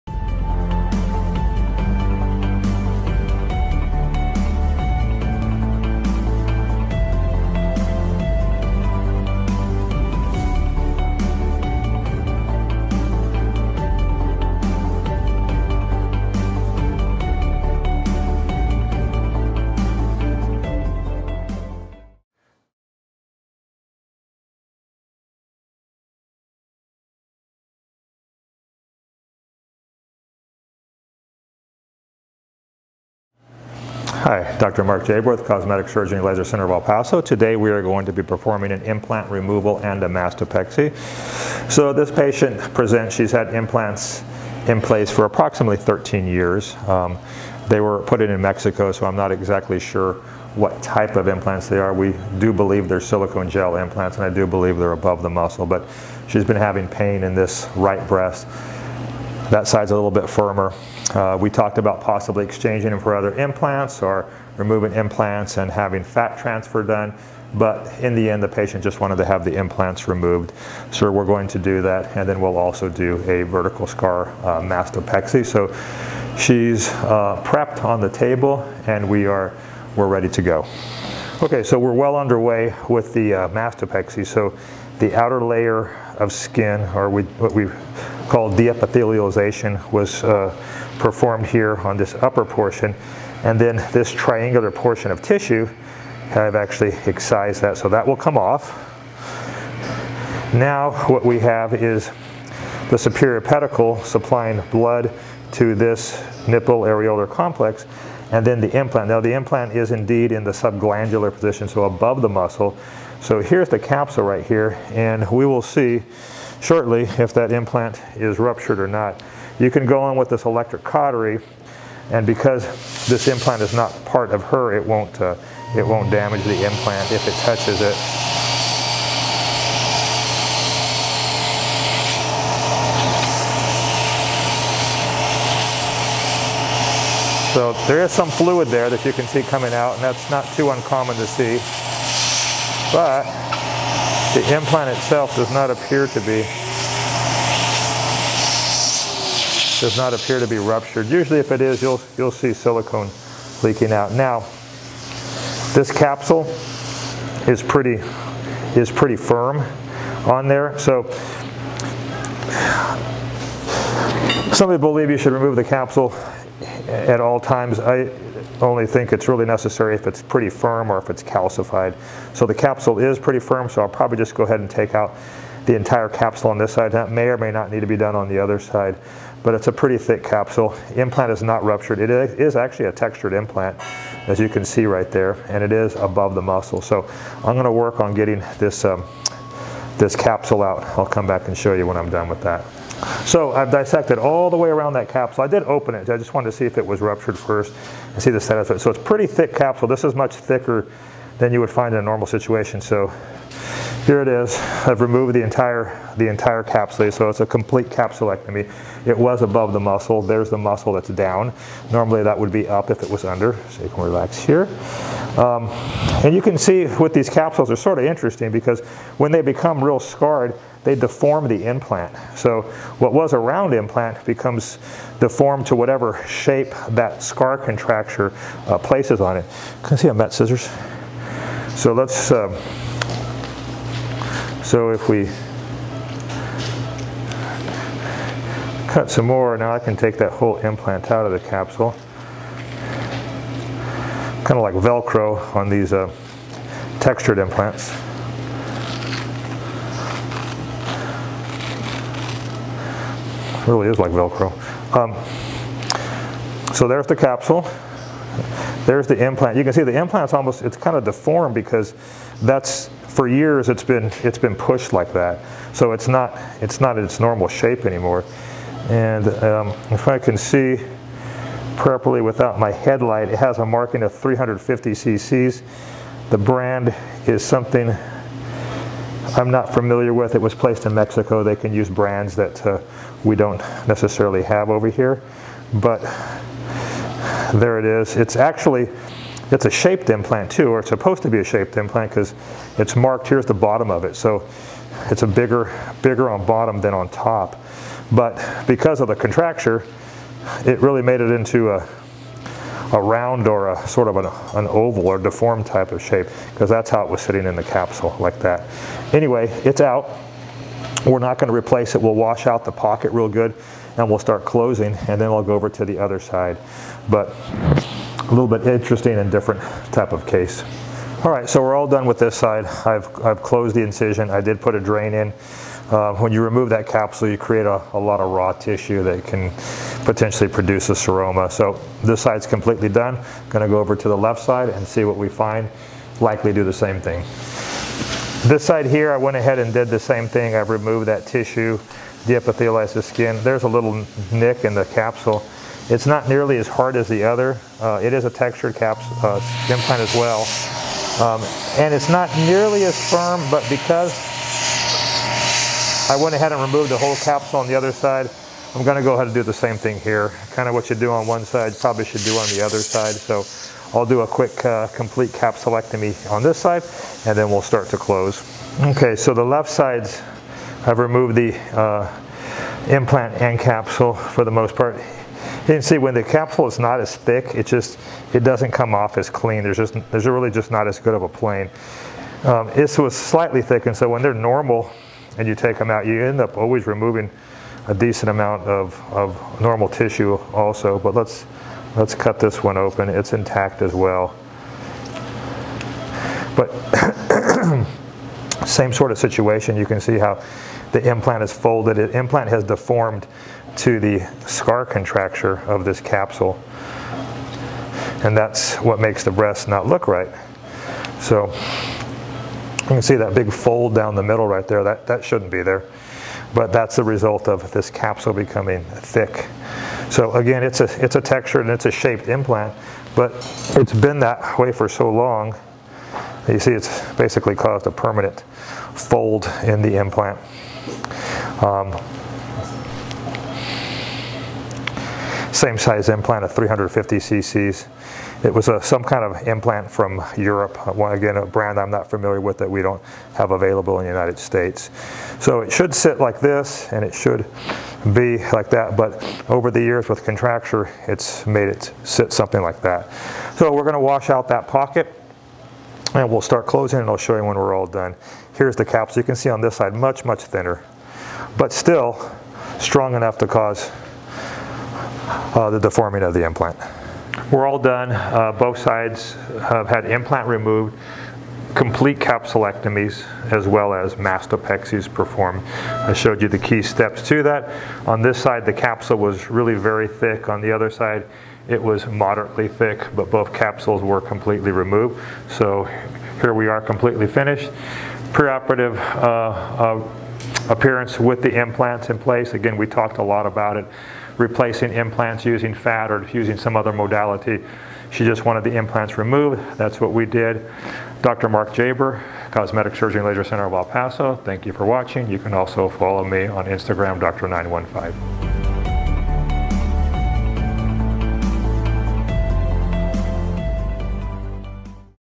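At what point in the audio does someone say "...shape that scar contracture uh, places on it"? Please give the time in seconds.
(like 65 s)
226 s.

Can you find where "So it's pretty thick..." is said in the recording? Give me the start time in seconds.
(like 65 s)
198 s.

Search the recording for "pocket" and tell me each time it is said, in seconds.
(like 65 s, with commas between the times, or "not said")
312 s, 454 s.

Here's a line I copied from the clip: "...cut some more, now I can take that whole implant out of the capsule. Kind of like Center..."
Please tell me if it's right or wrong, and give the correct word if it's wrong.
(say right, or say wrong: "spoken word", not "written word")
wrong: "Velcro", not "Center".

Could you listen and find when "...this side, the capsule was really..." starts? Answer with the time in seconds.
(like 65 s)
478 s.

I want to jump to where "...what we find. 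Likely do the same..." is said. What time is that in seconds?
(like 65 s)
335 s.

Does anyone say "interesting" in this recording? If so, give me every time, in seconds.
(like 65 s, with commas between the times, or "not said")
218 s, 318 s.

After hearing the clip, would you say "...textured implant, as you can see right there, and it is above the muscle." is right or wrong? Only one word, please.
right.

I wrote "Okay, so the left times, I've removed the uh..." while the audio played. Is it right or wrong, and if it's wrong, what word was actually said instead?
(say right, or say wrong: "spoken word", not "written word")
wrong: "sides", not "times".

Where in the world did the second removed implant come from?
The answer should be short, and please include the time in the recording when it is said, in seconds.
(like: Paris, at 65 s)
Europe, at 440 s.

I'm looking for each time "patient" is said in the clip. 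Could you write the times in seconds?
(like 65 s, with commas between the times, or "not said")
42 s, 68 s.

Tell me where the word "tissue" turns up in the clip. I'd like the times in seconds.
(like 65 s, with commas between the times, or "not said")
95 s, 328 s, 341 s, 389 s.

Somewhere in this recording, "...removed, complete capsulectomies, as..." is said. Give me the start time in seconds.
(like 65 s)
470 s.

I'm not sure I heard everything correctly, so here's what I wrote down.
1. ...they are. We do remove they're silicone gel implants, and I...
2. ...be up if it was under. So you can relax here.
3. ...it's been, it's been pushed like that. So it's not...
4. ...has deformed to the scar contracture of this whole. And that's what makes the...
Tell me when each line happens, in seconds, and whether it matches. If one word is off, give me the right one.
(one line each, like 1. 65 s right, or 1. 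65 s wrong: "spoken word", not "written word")
1. 51 s wrong: "believe", not "remove"
2. 212 s right
3. 263 s right
4. 402 s wrong: "capsule", not "whole".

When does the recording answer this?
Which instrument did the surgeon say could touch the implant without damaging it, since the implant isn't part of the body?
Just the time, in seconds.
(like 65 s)
120 s.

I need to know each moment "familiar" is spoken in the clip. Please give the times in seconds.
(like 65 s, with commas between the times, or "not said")
279 s, 442 s.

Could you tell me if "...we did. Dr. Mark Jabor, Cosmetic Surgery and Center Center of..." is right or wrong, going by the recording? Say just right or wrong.
wrong.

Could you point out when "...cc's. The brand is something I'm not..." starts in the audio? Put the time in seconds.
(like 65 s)
274 s.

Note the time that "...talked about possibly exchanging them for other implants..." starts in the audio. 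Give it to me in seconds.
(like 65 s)
61 s.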